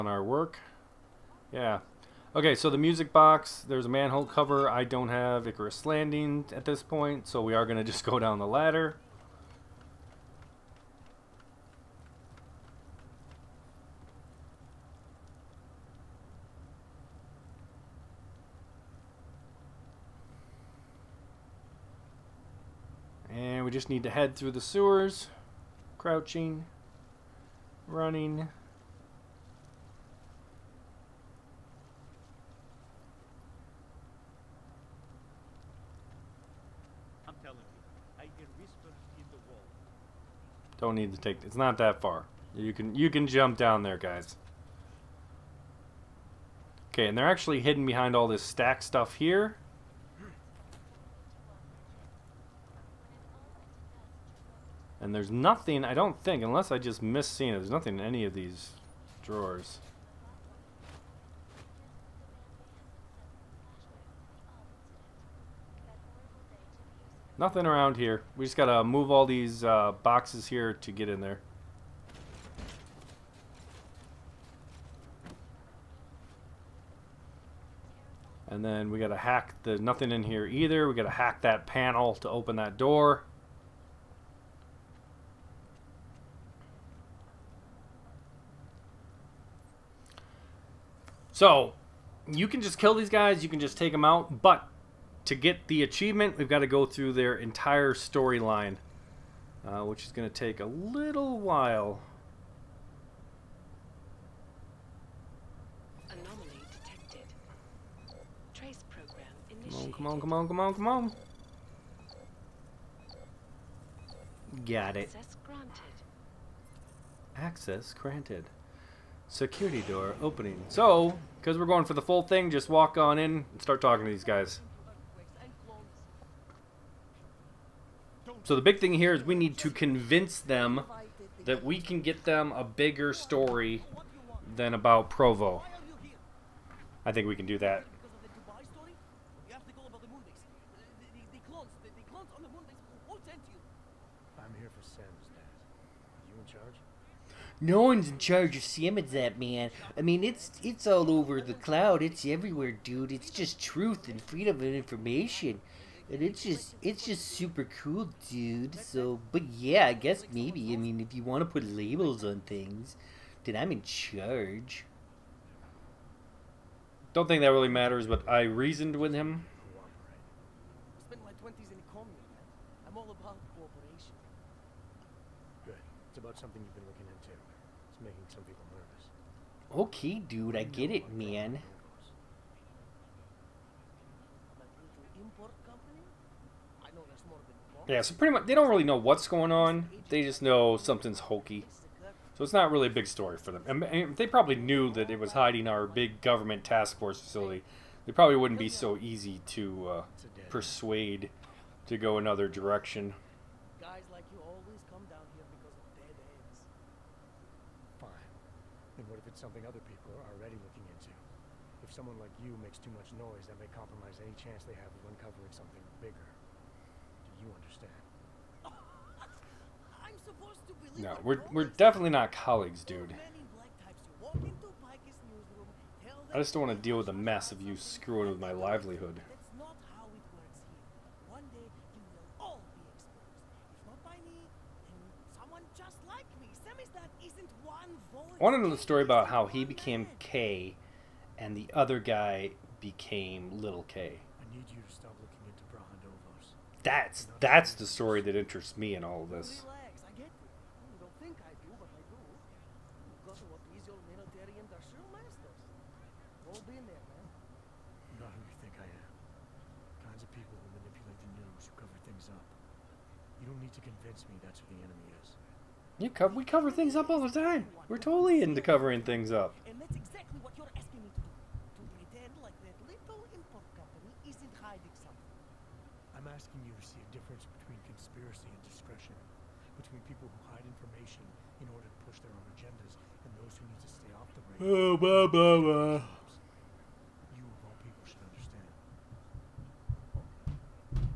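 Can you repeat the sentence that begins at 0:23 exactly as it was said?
And we just need to head through the sewers, crouching, running.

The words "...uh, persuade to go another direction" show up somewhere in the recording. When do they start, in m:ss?
3:19.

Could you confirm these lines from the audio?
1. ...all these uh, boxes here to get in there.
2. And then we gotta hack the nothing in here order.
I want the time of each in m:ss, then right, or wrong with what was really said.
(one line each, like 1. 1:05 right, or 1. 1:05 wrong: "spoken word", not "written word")
1. 1:09 right
2. 1:18 wrong: "either", not "order".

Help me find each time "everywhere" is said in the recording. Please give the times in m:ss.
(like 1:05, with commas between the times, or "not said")
2:32.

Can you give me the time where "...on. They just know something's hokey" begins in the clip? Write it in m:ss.
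3:09.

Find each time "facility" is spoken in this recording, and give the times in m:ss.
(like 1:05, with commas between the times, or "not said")
3:17.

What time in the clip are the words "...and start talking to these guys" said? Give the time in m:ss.
2:03.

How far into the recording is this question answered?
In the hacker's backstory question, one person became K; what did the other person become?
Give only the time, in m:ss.
4:03.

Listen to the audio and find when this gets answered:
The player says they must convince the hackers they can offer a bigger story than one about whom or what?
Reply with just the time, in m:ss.
2:15.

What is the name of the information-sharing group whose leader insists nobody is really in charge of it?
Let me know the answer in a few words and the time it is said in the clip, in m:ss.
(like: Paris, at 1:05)
Samizdat, at 2:28.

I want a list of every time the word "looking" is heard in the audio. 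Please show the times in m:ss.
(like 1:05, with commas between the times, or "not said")
2:56, 3:30.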